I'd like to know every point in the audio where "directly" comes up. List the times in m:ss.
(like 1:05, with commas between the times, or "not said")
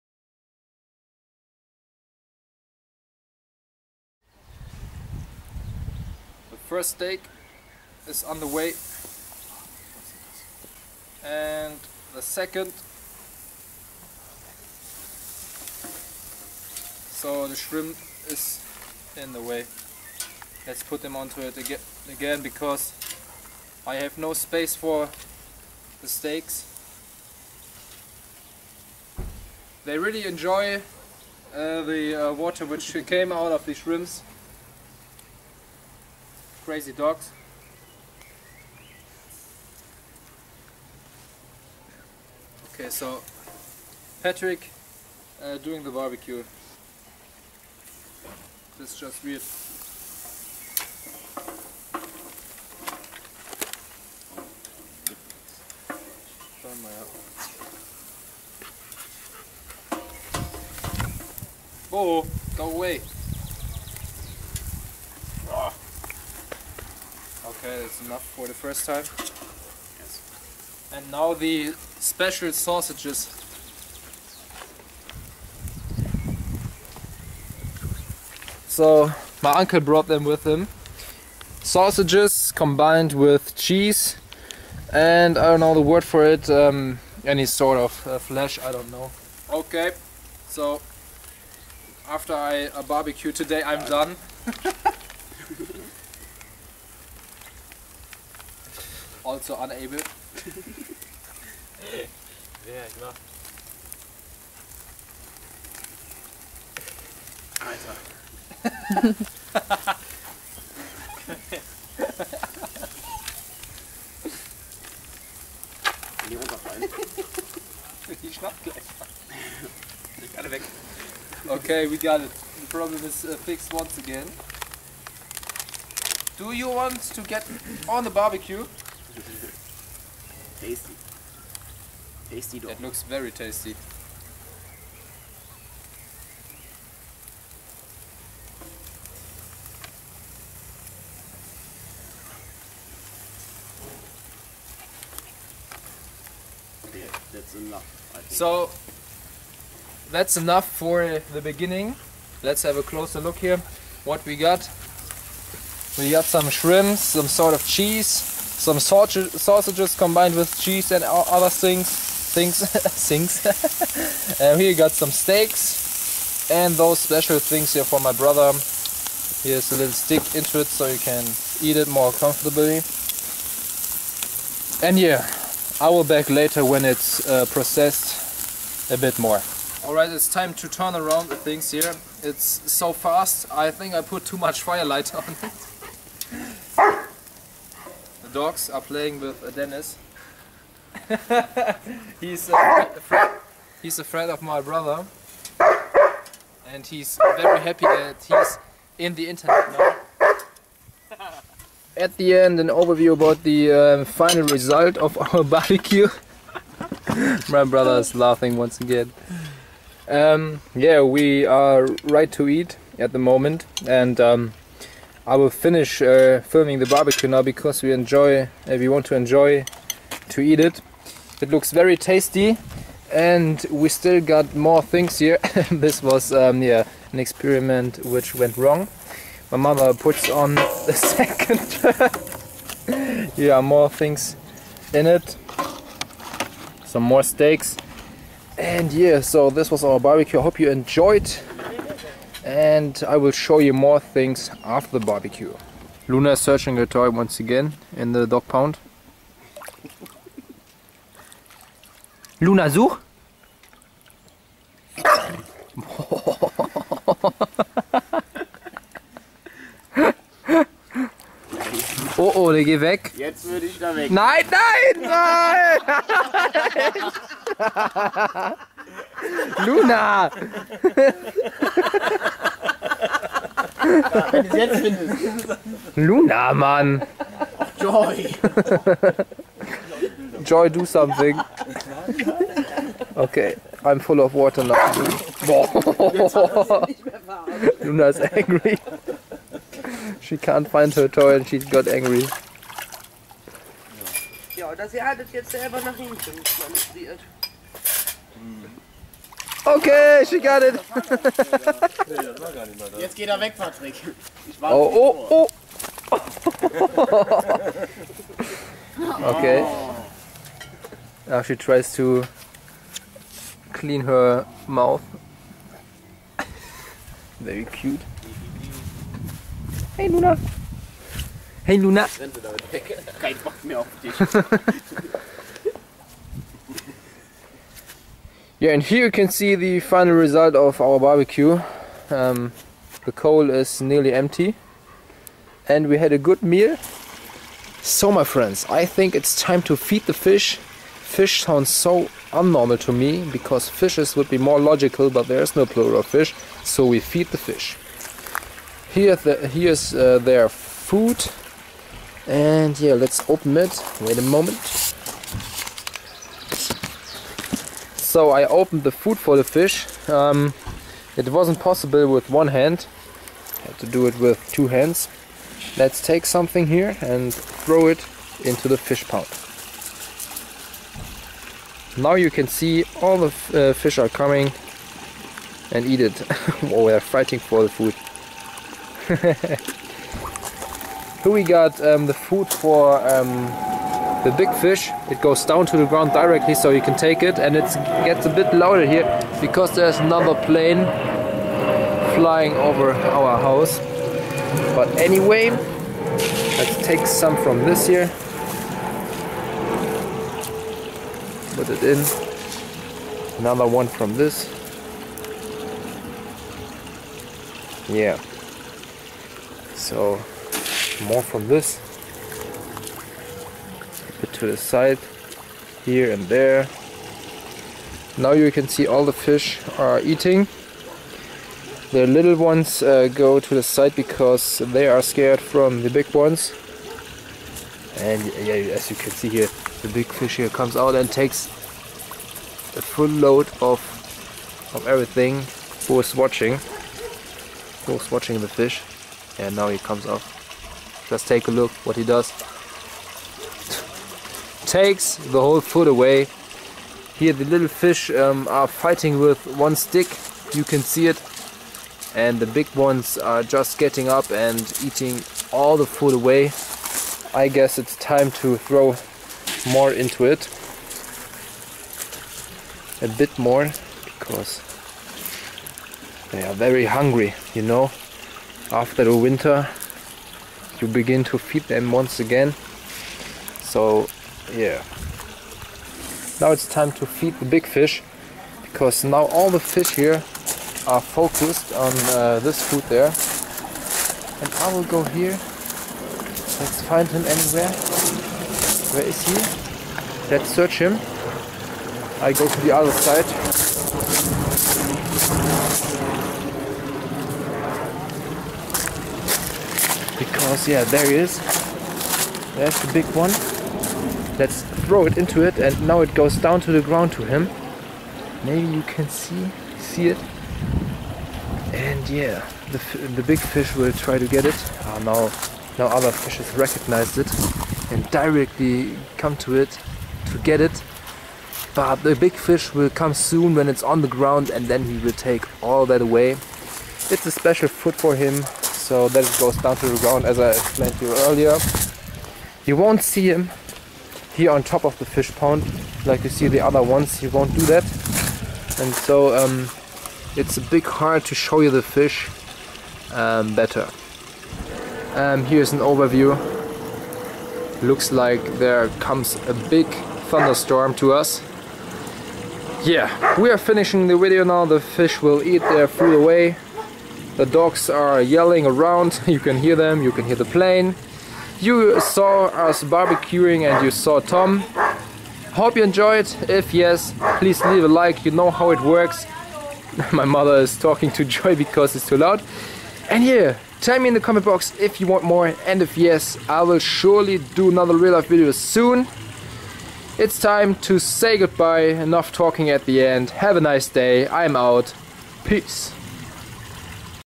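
6:26, 8:38.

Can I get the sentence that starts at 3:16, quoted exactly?
And he's very happy that he's in the internet now.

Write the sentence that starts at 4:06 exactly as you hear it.
Luna is searching her toy once again in the dog pound.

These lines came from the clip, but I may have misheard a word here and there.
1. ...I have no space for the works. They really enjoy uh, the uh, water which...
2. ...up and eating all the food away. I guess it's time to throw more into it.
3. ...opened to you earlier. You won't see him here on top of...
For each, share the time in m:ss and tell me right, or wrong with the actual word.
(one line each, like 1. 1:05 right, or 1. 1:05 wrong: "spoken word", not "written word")
1. 0:23 wrong: "steaks", not "works"
2. 7:34 right
3. 8:50 wrong: "explained", not "opened".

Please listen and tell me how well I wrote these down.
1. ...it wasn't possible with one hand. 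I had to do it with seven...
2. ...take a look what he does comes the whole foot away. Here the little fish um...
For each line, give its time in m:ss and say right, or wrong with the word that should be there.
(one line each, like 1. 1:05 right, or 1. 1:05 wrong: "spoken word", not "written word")
1. 6:01 wrong: "two", not "seven"
2. 7:21 wrong: "takes", not "comes".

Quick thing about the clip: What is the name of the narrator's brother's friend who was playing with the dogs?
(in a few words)
Dennis.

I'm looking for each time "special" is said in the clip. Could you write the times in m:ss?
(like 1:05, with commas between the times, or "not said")
1:11, 2:46, 8:47.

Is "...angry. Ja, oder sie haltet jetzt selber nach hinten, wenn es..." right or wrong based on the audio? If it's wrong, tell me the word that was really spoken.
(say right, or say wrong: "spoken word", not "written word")
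right.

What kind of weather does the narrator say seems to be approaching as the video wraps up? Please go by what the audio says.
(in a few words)
Thunderstorm.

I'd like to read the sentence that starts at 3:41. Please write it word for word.
It looks very tasty and we still got more things here.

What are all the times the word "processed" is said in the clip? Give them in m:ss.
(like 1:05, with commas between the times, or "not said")
2:57.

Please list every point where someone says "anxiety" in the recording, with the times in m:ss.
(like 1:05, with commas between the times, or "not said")
not said.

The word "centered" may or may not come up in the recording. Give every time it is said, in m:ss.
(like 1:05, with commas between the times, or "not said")
not said.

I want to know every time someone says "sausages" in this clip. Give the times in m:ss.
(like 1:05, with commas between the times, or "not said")
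1:12, 1:21, 2:38.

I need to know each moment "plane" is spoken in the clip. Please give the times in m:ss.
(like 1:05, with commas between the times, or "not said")
6:30, 9:20.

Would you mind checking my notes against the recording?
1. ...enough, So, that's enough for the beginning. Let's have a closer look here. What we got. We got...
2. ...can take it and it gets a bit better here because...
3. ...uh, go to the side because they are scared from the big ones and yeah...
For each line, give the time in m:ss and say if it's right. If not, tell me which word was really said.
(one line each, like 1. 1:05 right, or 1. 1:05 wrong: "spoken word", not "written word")
1. 2:27 right
2. 6:26 wrong: "louder", not "better"
3. 7:02 right.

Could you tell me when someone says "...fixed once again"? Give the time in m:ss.
2:03.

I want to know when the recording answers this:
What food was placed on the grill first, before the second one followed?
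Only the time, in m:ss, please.
0:06.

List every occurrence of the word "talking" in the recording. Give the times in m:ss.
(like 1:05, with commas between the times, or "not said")
9:30, 9:42.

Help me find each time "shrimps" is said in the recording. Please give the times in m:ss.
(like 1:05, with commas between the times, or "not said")
0:17, 0:33, 2:36.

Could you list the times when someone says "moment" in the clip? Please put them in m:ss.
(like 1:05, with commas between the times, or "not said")
3:33, 5:54.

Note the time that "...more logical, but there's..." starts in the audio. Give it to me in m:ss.
5:44.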